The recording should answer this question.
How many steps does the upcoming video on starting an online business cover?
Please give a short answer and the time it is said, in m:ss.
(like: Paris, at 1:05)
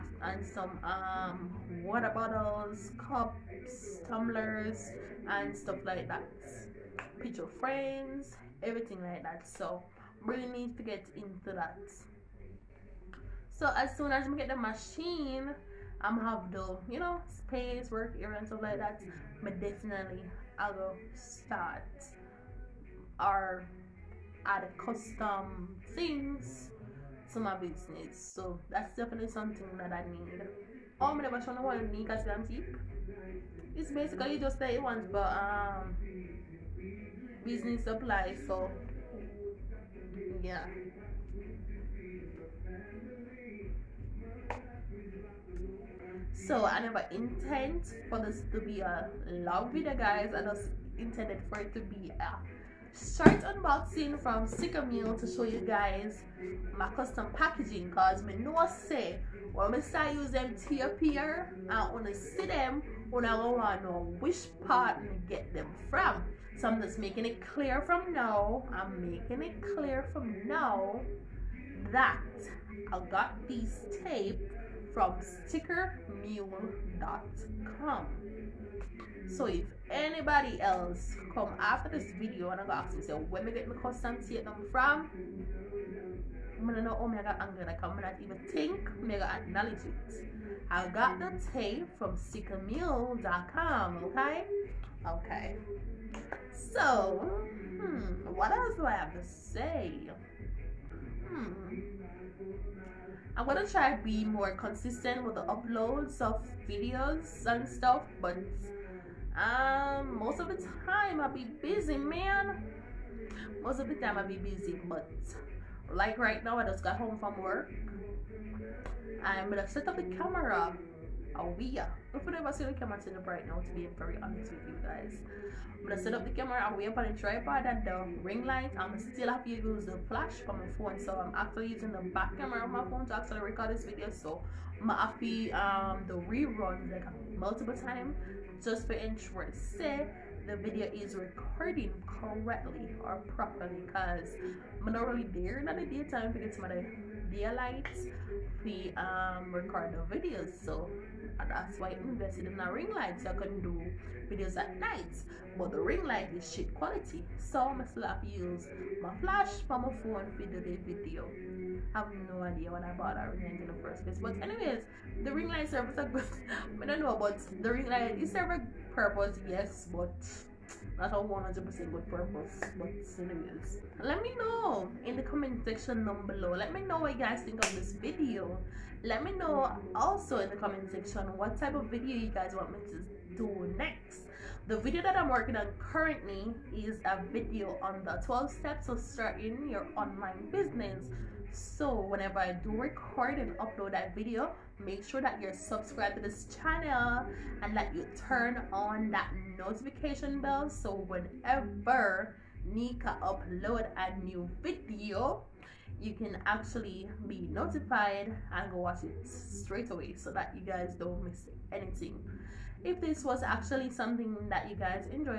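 12, at 3:08.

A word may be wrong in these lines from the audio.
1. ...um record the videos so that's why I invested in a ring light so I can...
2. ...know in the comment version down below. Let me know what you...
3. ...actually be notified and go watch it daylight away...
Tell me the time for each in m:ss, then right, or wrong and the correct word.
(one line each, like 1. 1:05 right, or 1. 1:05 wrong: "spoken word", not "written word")
1. 2:28 right
2. 2:54 wrong: "section", not "version"
3. 3:26 wrong: "straight", not "daylight".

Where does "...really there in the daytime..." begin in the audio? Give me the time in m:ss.
2:25.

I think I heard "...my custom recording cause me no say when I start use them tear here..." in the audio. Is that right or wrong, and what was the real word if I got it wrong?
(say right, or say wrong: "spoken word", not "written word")
wrong: "packaging", not "recording".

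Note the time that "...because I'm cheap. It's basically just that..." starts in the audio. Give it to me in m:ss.
0:31.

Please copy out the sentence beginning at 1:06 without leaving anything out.
So I'm just making it clear from now.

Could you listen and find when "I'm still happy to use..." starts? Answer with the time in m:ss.
2:08.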